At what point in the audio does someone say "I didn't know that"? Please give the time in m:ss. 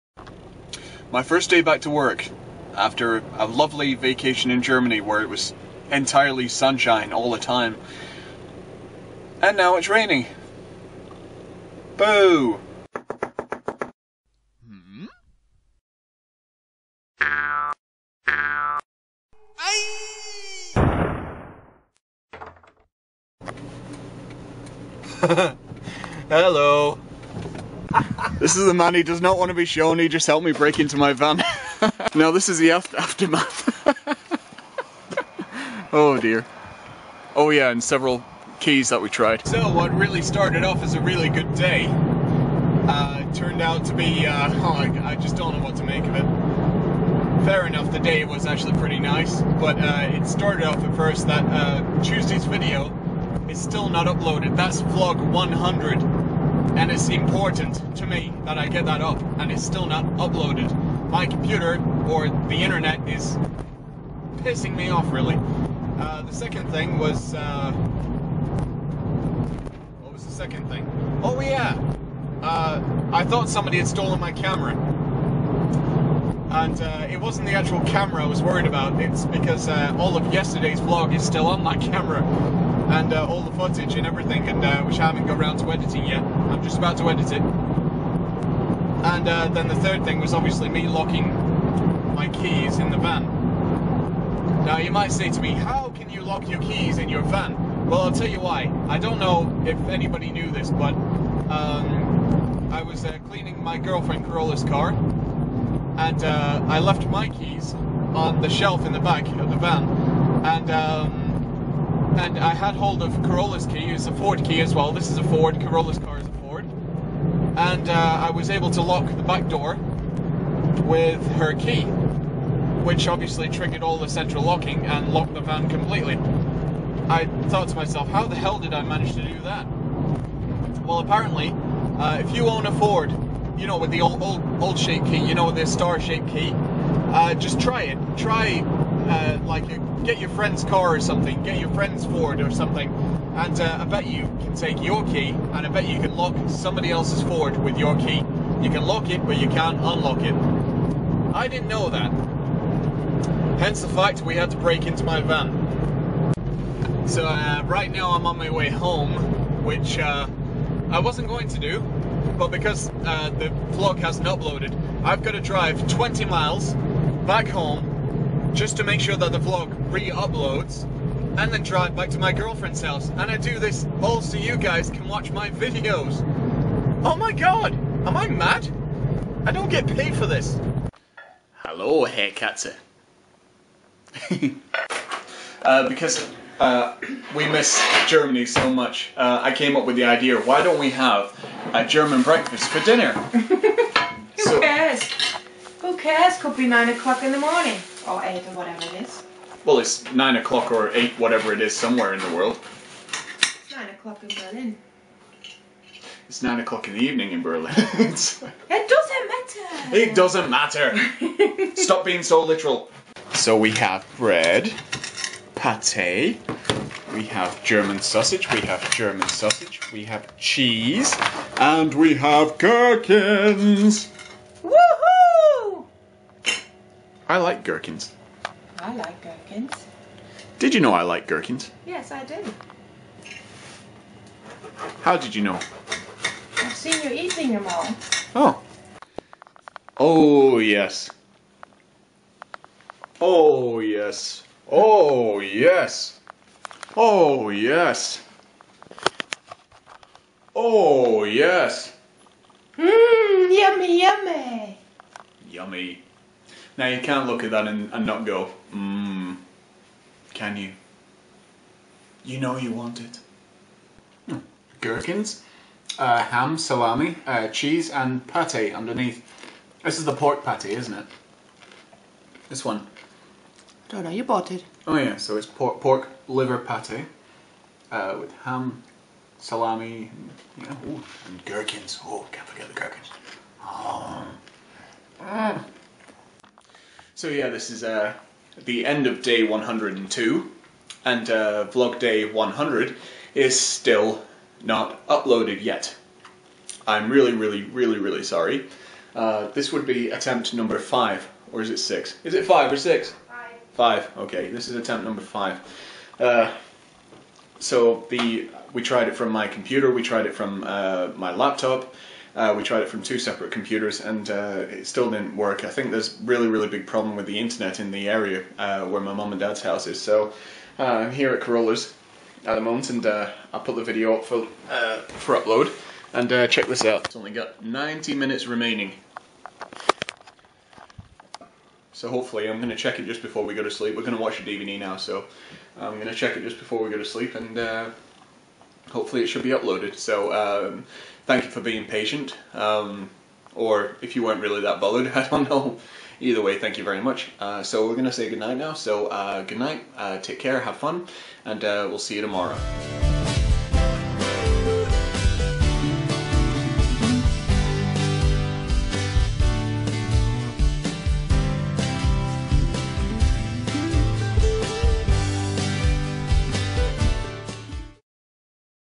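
2:31.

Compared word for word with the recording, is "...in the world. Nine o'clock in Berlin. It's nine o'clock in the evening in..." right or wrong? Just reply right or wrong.
right.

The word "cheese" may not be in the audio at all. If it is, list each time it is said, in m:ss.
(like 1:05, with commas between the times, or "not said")
3:40, 4:27.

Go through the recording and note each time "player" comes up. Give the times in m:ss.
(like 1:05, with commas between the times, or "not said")
not said.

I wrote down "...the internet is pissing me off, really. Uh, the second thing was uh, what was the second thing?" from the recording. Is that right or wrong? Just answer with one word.
right.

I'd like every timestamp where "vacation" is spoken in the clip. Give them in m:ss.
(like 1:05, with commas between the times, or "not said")
0:03.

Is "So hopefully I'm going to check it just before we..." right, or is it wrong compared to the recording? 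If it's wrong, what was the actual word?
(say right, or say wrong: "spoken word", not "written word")
right.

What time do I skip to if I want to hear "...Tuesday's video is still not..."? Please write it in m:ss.
0:52.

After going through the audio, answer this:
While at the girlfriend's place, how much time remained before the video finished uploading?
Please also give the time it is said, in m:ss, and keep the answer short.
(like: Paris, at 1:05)
90 minutes, at 5:27.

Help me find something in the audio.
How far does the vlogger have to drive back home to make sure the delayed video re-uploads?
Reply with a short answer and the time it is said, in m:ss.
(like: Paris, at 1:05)
20 miles, at 2:45.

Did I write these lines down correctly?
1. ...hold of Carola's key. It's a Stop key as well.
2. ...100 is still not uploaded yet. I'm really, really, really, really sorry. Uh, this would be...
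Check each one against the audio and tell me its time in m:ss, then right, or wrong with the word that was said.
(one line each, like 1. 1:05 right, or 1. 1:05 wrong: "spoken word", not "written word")
1. 1:52 wrong: "Ford", not "Stop"
2. 4:52 right.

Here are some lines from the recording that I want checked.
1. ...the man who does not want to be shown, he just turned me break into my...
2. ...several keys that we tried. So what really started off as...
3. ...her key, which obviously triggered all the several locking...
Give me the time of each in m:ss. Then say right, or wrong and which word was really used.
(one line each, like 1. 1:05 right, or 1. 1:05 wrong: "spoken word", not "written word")
1. 0:28 wrong: "helped", not "turned"
2. 0:37 right
3. 2:01 wrong: "central", not "several".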